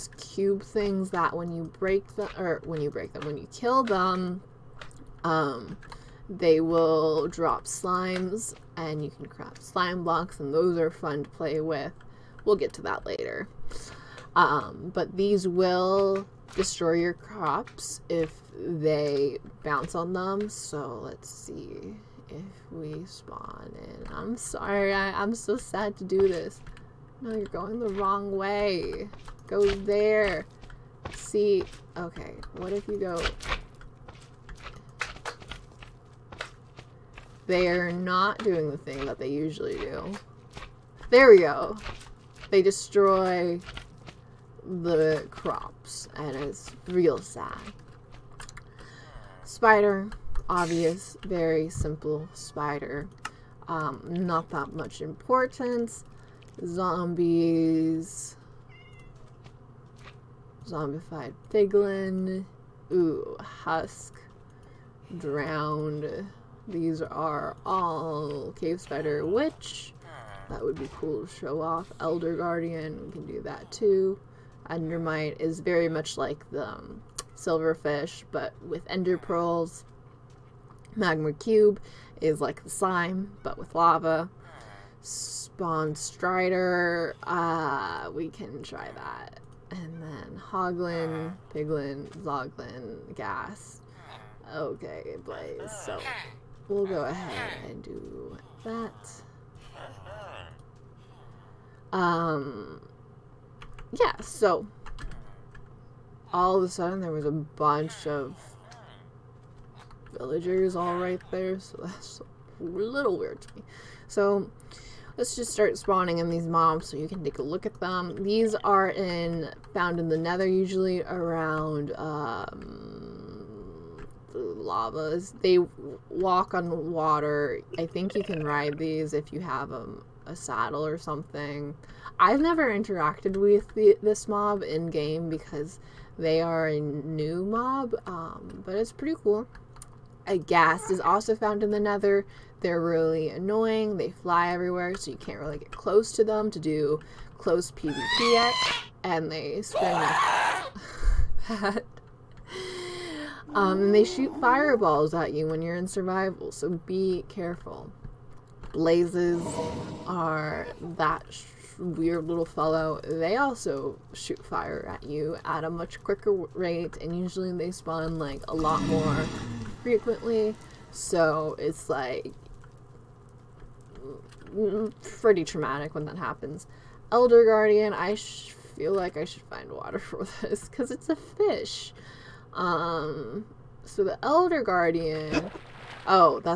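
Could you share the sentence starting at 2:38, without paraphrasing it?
Blazes are that weird little fellow.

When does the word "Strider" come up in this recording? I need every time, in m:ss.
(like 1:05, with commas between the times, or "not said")
1:25.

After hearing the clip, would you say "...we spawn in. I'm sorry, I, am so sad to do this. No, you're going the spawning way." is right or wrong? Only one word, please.
wrong.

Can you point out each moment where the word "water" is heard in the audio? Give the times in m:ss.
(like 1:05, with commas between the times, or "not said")
2:06, 2:59.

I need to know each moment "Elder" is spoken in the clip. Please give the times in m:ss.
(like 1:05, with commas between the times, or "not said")
1:12, 2:57, 3:04.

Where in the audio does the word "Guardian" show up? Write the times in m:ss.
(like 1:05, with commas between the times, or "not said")
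1:12, 2:57, 3:04.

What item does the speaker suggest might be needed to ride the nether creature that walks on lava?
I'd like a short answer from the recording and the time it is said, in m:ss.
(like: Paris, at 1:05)
A saddle, at 2:10.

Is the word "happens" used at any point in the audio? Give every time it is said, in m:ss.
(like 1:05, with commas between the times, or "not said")
2:56.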